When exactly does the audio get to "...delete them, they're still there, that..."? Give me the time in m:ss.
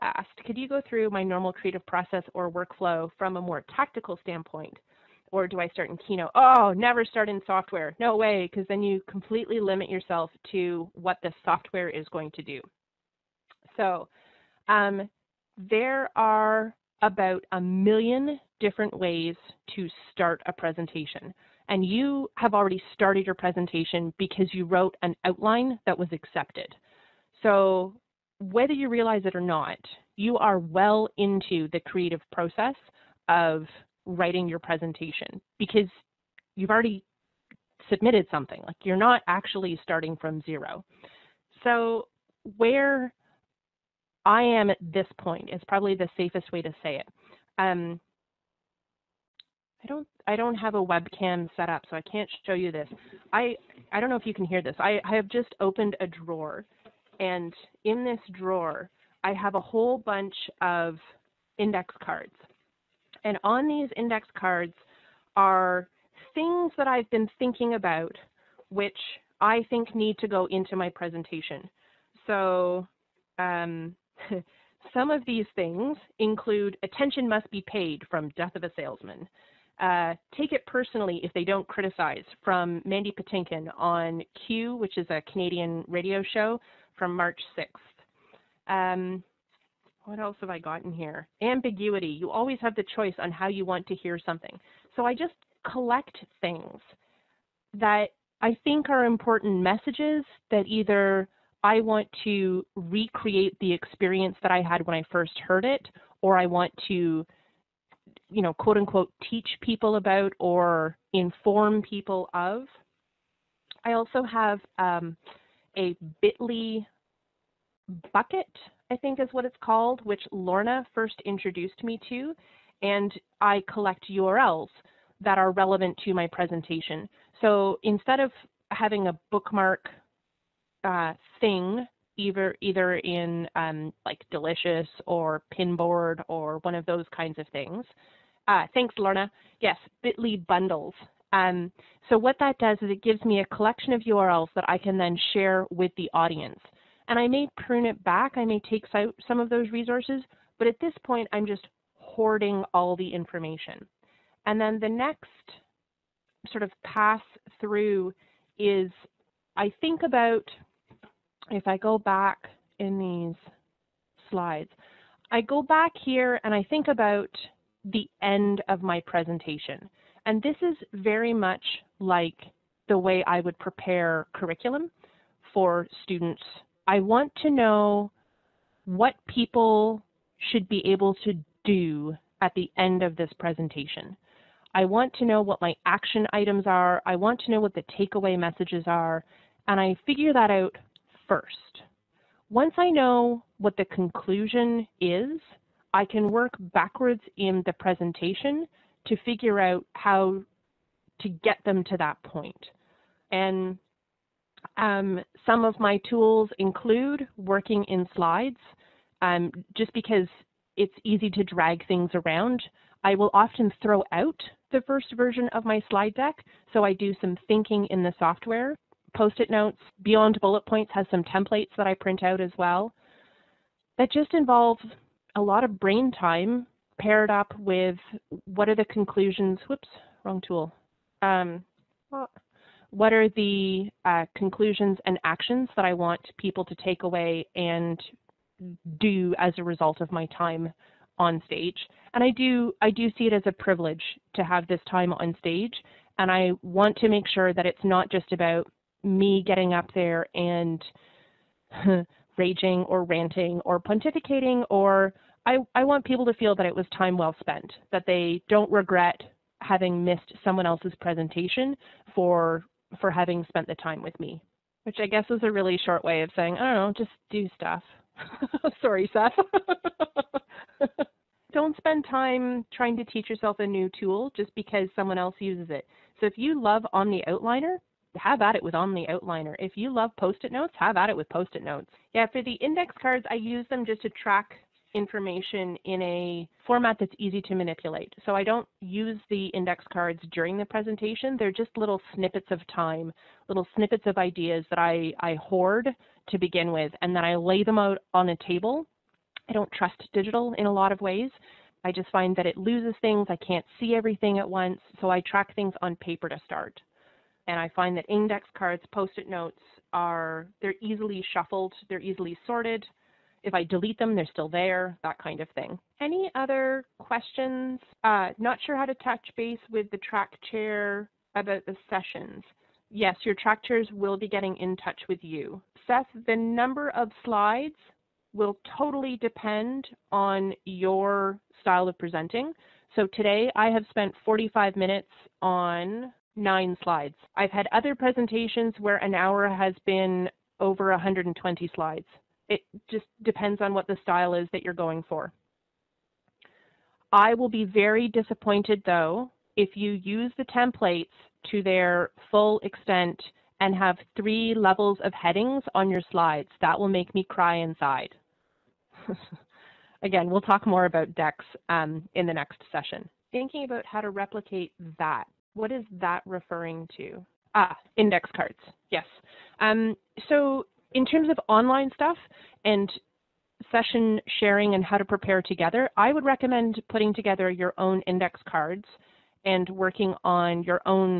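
5:13.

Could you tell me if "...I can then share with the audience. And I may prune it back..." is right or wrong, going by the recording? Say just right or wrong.
right.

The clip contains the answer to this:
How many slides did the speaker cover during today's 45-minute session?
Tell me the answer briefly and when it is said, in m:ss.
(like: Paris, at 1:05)
9, at 5:36.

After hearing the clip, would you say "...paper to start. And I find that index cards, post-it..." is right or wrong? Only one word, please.
right.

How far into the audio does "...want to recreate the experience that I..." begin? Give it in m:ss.
1:41.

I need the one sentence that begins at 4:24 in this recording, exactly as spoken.
Which I guess is a really short way of saying, I don't know, just do stuff.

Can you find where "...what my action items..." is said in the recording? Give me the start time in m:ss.
3:05.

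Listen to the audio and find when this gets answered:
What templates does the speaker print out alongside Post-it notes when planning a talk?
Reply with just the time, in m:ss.
3:40.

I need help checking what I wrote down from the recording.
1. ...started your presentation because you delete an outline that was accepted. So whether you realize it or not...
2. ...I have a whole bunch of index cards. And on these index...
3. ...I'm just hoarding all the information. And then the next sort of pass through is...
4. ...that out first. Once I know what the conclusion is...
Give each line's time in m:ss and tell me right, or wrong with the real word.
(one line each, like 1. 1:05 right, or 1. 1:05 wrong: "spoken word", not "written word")
1. 0:22 wrong: "wrote", not "delete"
2. 0:59 right
3. 2:31 right
4. 3:10 right.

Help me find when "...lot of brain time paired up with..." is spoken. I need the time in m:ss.
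3:45.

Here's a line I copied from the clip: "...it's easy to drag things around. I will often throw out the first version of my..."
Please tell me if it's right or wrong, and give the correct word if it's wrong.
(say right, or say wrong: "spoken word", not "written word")
right.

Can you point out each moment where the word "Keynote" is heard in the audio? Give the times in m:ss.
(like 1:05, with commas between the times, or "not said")
0:05.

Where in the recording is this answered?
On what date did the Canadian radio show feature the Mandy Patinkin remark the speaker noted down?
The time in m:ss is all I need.
1:27.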